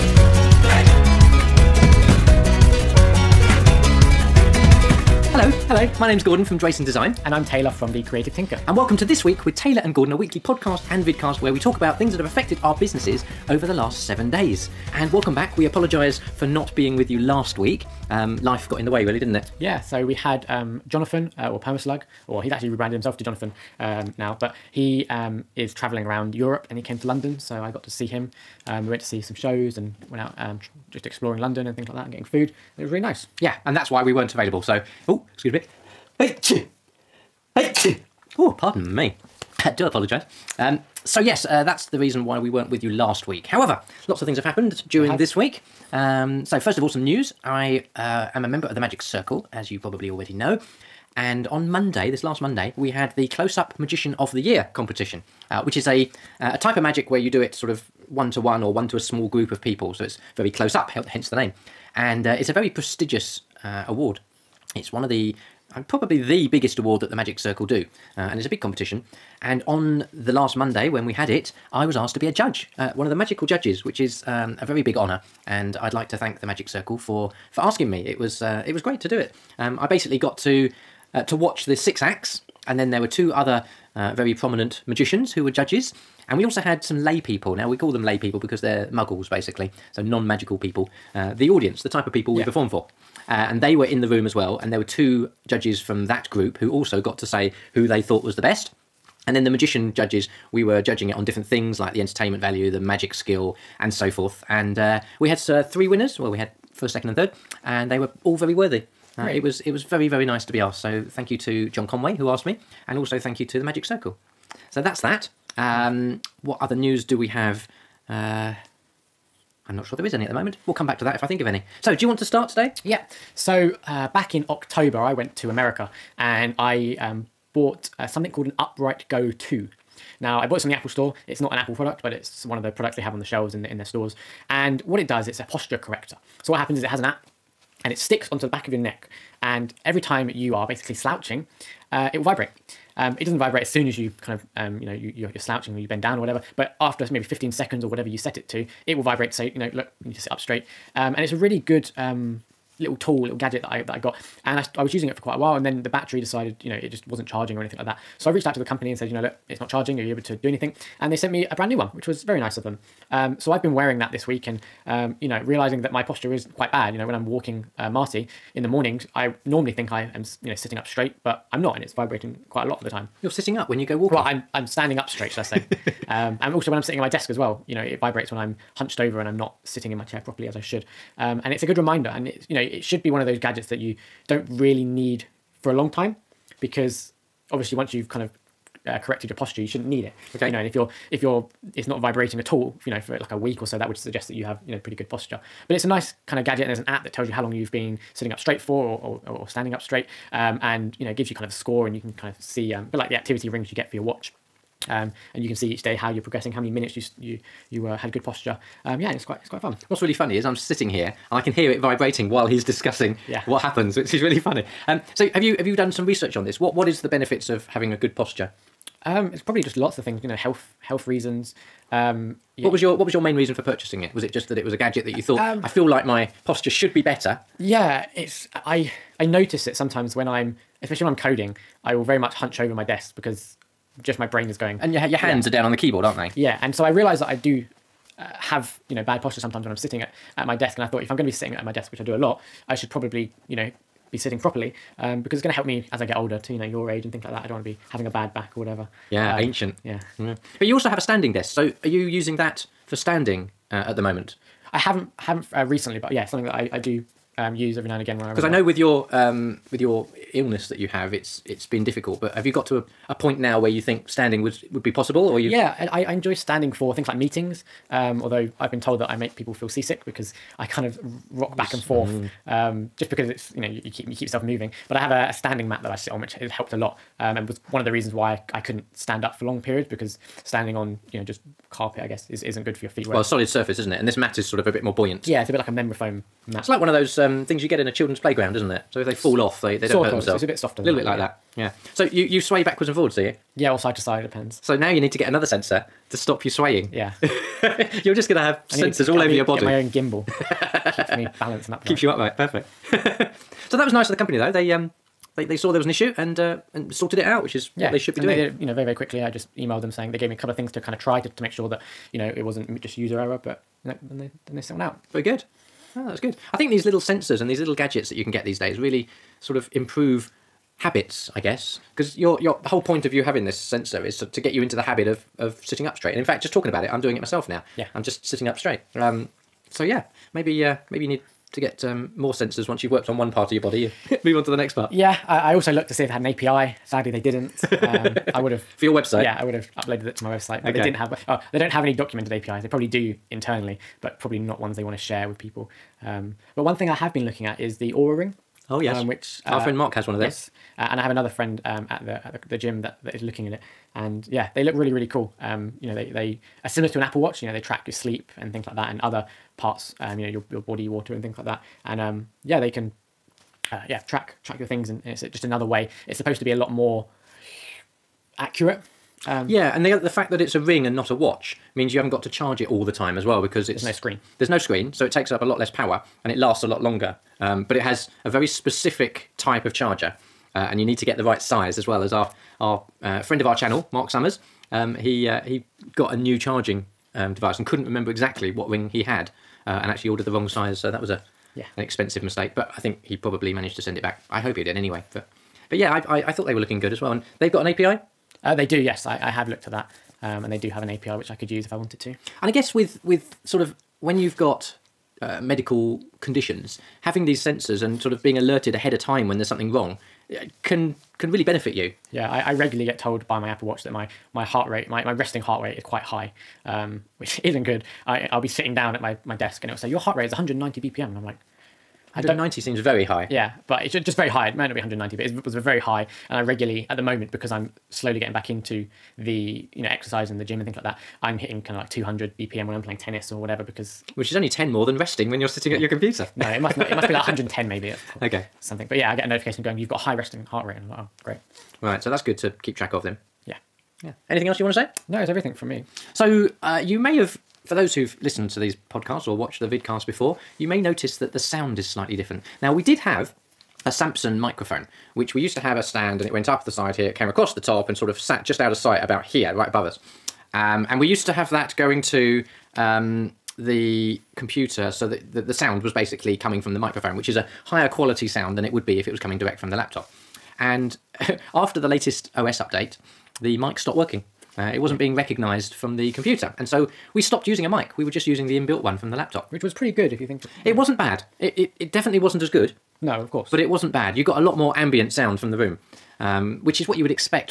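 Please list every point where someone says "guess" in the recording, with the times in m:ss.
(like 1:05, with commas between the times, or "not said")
4:42, 5:21, 6:42.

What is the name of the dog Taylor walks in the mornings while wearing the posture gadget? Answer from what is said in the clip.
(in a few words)
Marty.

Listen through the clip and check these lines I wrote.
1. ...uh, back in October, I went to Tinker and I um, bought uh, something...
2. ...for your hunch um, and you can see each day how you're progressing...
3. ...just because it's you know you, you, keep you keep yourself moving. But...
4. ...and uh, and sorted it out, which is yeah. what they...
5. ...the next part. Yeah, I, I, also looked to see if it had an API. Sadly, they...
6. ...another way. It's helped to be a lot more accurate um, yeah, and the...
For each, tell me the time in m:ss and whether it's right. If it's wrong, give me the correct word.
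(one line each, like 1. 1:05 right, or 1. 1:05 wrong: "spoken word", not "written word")
1. 2:03 wrong: "America", not "Tinker"
2. 3:23 wrong: "watch", not "hunch"
3. 4:32 right
4. 5:06 right
5. 5:34 right
6. 6:05 wrong: "supposed", not "helped".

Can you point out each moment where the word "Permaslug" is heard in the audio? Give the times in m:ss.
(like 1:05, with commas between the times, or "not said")
0:21.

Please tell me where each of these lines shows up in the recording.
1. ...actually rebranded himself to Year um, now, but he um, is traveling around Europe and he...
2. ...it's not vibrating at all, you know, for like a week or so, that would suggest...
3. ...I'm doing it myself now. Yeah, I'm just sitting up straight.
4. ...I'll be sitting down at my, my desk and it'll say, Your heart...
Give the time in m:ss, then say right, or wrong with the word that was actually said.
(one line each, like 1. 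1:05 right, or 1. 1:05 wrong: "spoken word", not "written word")
1. 0:22 wrong: "Jonathan", not "Year"
2. 3:11 right
3. 5:26 right
4. 6:58 right.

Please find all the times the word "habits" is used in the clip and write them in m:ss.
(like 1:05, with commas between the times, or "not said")
5:20, 5:24.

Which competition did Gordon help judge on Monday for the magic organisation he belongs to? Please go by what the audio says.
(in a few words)
Close Up Magician of the Year.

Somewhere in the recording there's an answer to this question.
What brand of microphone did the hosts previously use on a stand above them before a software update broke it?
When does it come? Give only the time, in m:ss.
7:33.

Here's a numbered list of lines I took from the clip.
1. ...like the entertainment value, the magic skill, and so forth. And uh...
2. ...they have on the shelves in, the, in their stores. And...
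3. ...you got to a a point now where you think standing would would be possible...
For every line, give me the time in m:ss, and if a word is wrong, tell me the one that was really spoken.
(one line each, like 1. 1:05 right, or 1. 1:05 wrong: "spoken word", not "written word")
1. 1:41 right
2. 2:12 right
3. 4:22 right.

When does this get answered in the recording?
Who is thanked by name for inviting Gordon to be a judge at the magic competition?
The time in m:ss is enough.
1:51.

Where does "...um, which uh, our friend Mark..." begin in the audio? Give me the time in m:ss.
5:49.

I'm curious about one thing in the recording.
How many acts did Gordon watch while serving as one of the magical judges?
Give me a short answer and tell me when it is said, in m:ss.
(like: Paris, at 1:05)
6, at 1:21.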